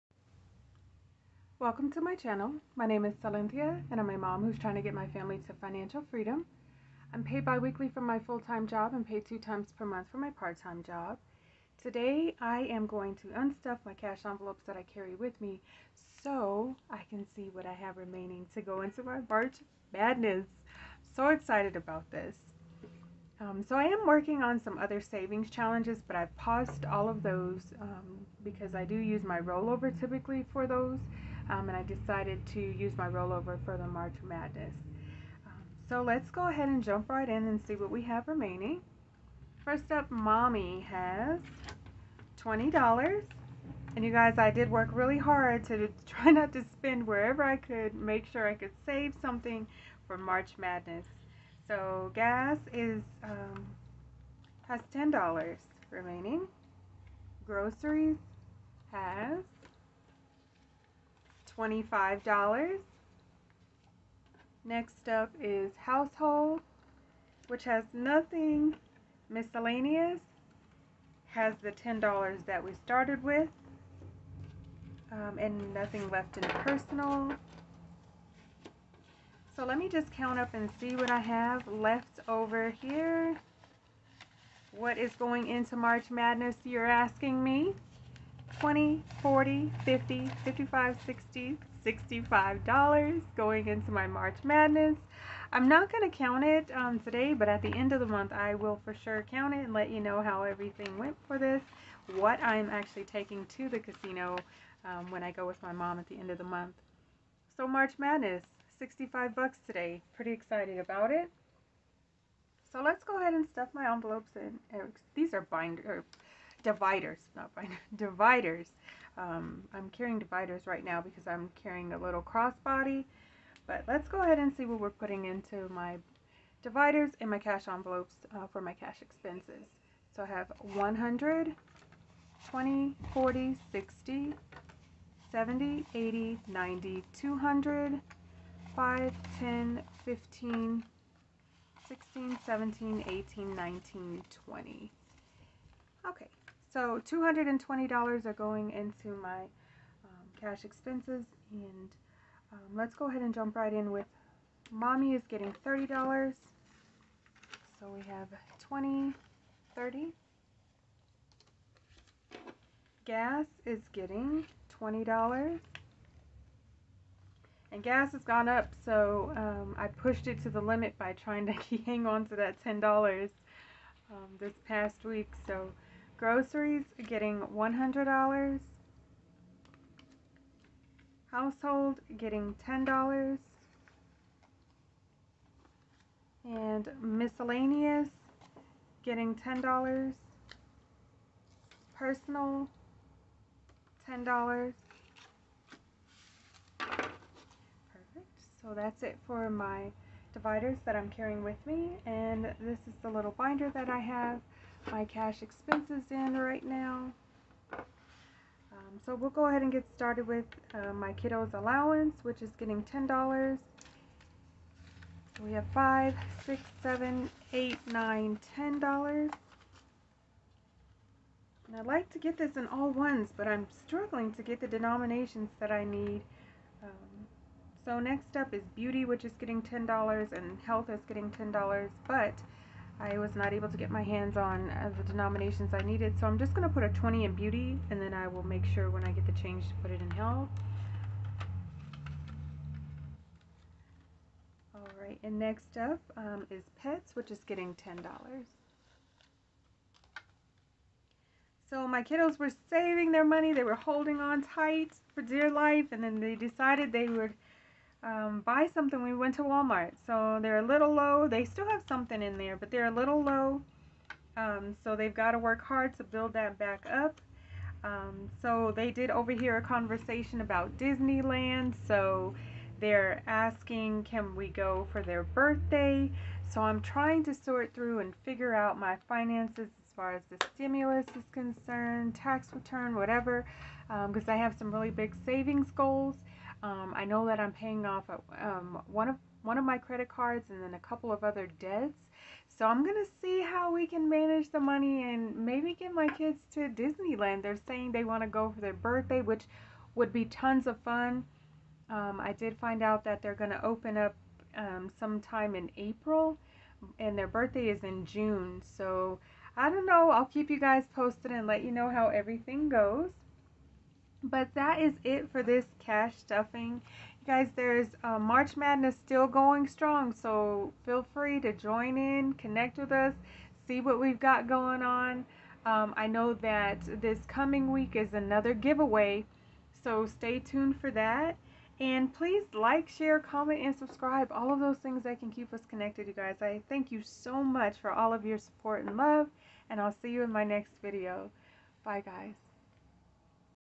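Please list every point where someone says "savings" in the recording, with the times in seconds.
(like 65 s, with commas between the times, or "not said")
24 s, 252 s, 285 s.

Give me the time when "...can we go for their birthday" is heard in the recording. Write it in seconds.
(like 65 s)
274 s.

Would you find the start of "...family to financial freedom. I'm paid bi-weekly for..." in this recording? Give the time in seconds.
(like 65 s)
5 s.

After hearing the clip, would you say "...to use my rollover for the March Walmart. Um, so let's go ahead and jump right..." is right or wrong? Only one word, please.
wrong.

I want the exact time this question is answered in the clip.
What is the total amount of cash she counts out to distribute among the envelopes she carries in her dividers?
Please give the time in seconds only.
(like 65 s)
147 s.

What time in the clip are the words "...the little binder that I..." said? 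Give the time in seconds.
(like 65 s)
203 s.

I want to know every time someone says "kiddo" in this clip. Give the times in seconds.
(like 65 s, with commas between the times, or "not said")
211 s, 252 s.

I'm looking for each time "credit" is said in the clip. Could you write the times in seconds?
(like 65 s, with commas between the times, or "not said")
289 s.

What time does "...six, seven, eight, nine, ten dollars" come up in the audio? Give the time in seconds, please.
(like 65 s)
216 s.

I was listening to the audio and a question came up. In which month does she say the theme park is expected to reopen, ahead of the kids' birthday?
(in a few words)
April.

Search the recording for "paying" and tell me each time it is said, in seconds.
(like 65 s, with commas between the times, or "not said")
287 s.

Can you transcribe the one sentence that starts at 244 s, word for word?
Alright, and next up um, is pets, which is getting $10.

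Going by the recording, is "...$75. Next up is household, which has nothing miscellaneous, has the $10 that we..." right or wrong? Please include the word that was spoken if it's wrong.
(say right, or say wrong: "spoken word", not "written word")
wrong: "25", not "75".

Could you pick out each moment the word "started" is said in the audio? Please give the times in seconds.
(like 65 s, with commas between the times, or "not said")
72 s, 209 s.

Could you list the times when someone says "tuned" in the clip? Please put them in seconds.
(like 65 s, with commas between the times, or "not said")
330 s.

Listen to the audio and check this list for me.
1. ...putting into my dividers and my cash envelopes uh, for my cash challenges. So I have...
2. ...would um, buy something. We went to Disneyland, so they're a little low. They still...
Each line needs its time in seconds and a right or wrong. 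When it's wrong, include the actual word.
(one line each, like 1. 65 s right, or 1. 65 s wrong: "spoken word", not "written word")
1. 124 s wrong: "expenses", not "challenges"
2. 257 s wrong: "Walmart", not "Disneyland".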